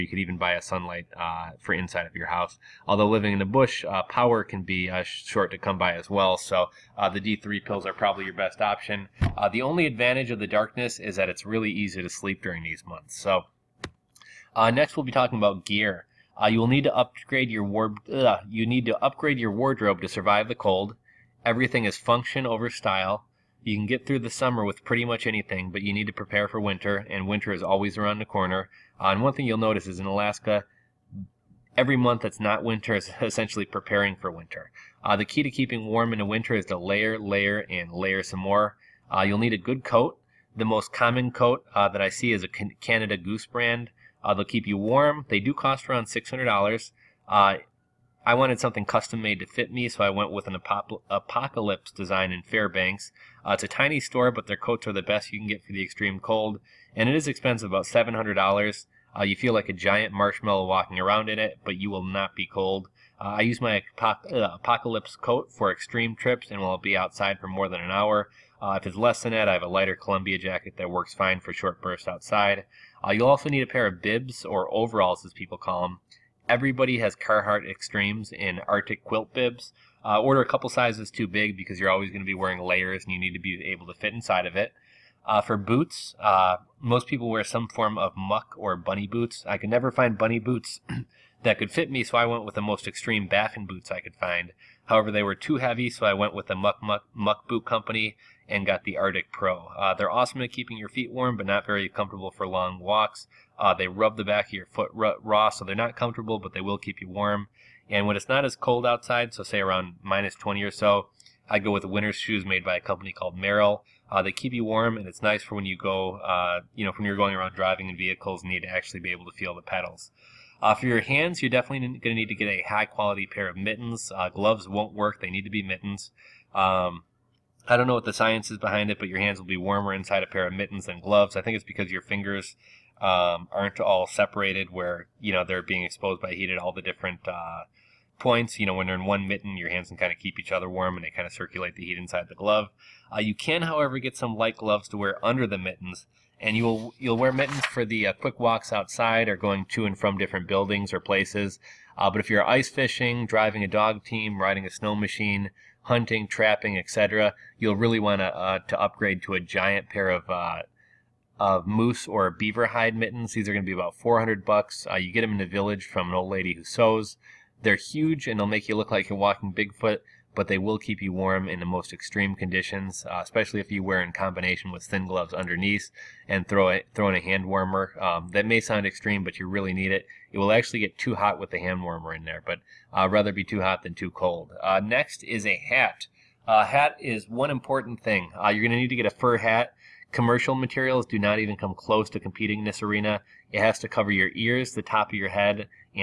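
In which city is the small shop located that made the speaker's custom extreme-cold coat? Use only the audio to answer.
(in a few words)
Fairbanks.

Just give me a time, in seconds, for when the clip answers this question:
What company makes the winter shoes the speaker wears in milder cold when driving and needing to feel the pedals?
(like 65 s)
113 s.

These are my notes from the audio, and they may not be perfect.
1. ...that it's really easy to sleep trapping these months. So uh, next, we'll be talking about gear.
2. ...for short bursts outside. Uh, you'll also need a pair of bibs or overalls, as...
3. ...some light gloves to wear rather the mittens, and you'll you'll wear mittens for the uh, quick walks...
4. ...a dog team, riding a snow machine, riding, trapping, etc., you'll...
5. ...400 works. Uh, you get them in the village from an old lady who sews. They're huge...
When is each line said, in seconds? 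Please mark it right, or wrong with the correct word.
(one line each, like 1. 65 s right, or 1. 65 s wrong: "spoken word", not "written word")
1. 11 s wrong: "during", not "trapping"
2. 71 s right
3. 144 s wrong: "under", not "rather"
4. 153 s wrong: "hunting", not "riding"
5. 163 s wrong: "bucks", not "works".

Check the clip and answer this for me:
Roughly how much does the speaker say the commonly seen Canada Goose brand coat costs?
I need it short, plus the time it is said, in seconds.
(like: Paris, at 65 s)
$600, at 46 s.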